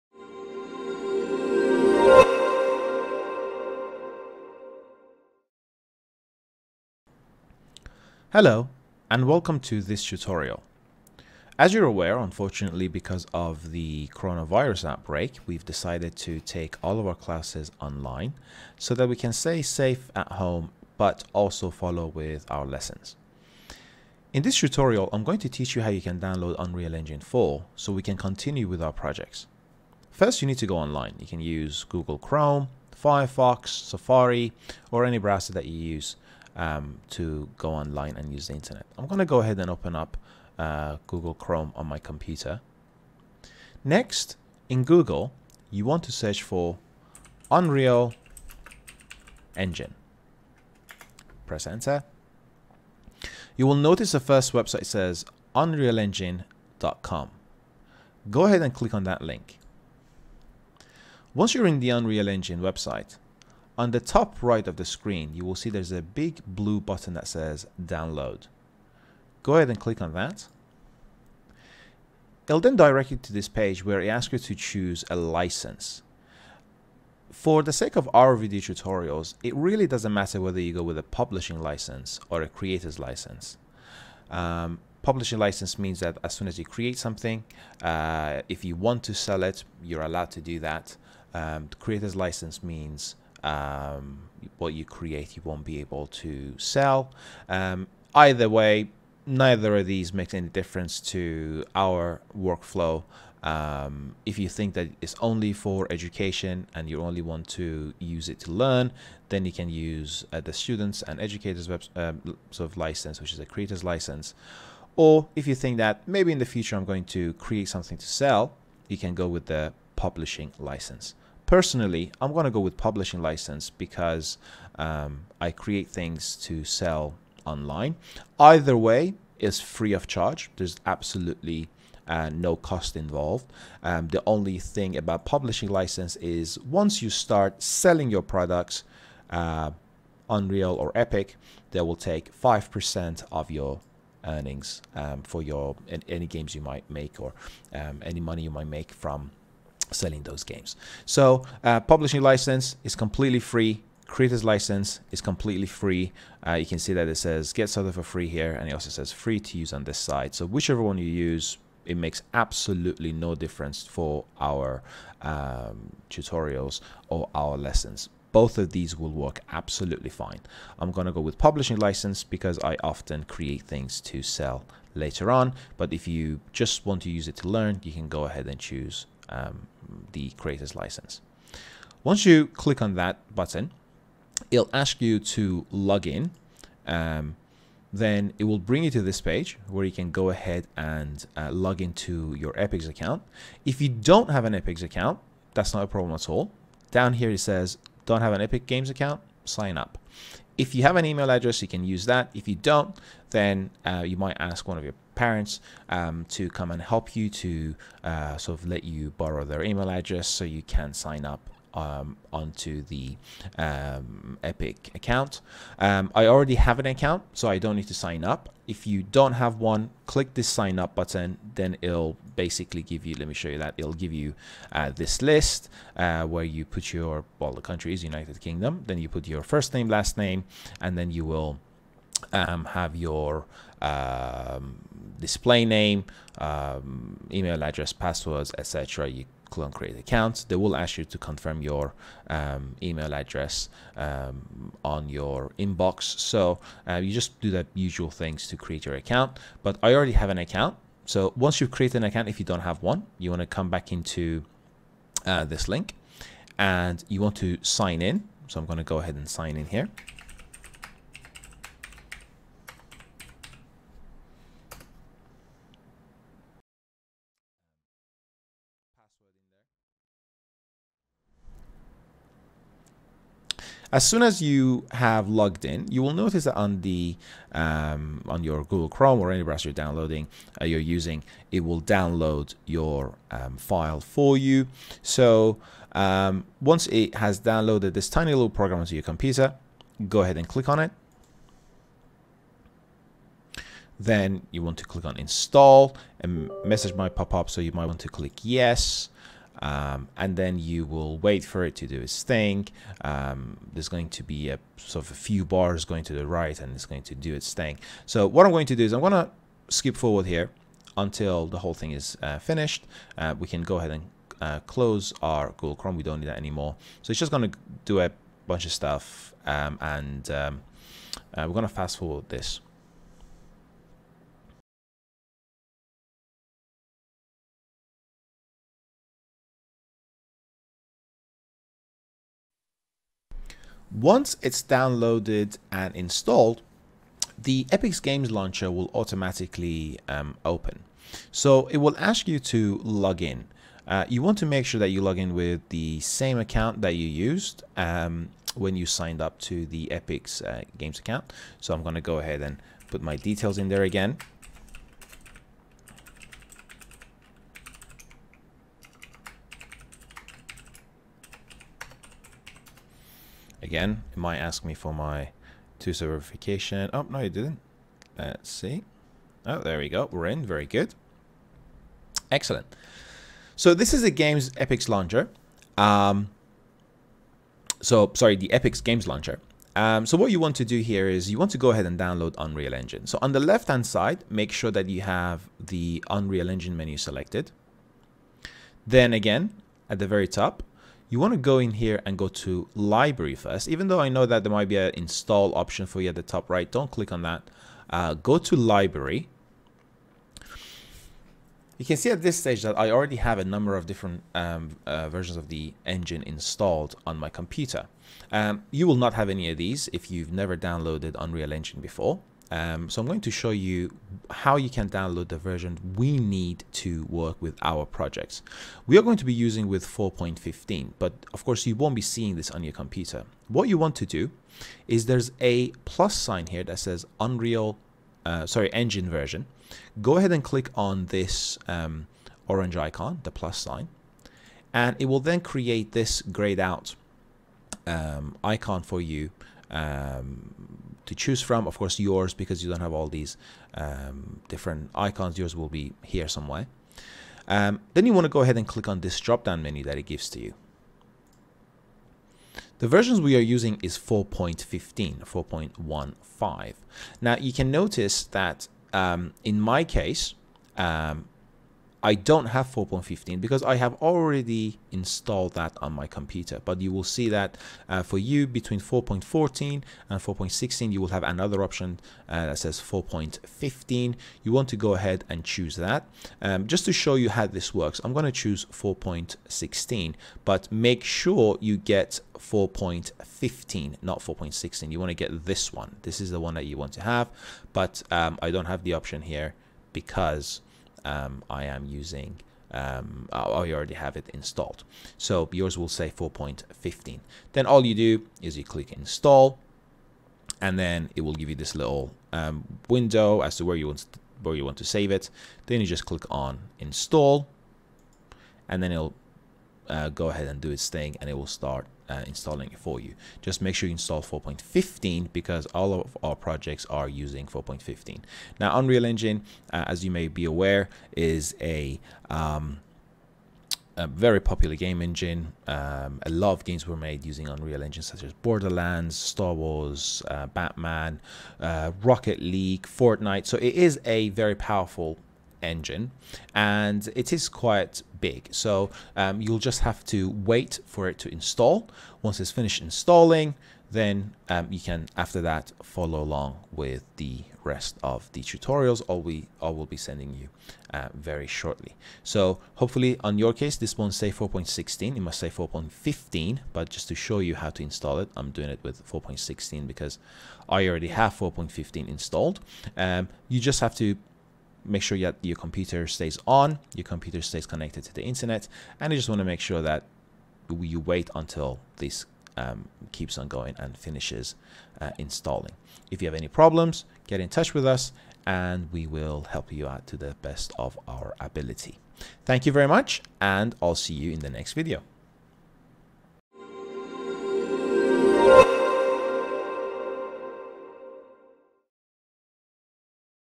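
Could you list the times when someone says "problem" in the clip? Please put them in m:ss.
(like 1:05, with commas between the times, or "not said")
3:15, 9:36.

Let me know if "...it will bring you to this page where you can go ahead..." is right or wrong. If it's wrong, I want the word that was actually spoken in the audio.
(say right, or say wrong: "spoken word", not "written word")
right.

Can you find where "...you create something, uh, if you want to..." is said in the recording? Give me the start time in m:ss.
1:26.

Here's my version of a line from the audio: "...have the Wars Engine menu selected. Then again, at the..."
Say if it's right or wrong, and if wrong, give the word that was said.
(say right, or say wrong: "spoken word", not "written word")
wrong: "Unreal", not "Wars".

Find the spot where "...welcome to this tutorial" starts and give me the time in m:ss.
0:09.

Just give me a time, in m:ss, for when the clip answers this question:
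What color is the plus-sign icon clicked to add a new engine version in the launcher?
7:12.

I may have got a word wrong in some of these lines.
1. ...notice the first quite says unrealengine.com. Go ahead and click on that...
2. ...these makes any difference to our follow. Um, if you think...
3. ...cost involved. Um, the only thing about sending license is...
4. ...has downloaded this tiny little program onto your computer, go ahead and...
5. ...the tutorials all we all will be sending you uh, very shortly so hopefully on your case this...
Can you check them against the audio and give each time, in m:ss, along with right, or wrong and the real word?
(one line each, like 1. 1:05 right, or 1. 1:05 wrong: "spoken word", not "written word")
1. 0:53 wrong: "website", not "quite"
2. 1:39 wrong: "workflow", not "follow"
3. 2:12 wrong: "publishing", not "sending"
4. 4:47 right
5. 9:08 right.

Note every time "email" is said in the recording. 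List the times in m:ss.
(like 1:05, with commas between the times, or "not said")
3:21, 3:29, 3:57, 4:02.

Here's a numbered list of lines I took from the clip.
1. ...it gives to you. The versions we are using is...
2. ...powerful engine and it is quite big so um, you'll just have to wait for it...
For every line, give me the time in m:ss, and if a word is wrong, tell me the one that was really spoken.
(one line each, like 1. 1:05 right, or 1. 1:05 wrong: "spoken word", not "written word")
1. 7:29 right
2. 8:54 right.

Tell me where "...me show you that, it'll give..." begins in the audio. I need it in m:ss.
3:43.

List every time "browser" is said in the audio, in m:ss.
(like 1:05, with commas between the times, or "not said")
0:35, 4:39.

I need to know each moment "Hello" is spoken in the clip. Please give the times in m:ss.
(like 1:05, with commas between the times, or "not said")
0:08.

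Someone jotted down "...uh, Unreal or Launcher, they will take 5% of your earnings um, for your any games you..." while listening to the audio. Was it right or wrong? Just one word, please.
wrong.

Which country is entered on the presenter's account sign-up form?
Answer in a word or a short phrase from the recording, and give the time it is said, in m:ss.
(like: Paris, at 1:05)
United Kingdom, at 3:48.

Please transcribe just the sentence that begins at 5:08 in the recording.
So what I'm going to do is I'm going to skip forward here until the whole thing is uh, finished.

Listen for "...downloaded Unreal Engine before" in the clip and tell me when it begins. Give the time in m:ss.
6:50.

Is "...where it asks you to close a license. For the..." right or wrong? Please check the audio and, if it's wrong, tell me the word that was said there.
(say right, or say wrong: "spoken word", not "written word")
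wrong: "choose", not "close".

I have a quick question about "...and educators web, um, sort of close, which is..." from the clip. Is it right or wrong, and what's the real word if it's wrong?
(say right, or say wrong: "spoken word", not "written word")
wrong: "license", not "close".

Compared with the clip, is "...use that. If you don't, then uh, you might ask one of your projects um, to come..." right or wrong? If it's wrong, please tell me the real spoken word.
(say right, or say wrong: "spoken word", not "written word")
wrong: "parents", not "projects".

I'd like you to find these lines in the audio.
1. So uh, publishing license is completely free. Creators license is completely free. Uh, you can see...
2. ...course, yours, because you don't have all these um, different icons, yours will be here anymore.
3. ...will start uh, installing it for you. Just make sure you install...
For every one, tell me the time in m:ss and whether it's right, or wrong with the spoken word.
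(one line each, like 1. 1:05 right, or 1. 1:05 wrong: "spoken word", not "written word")
1. 2:31 right
2. 7:21 wrong: "somewhere", not "anymore"
3. 8:31 right.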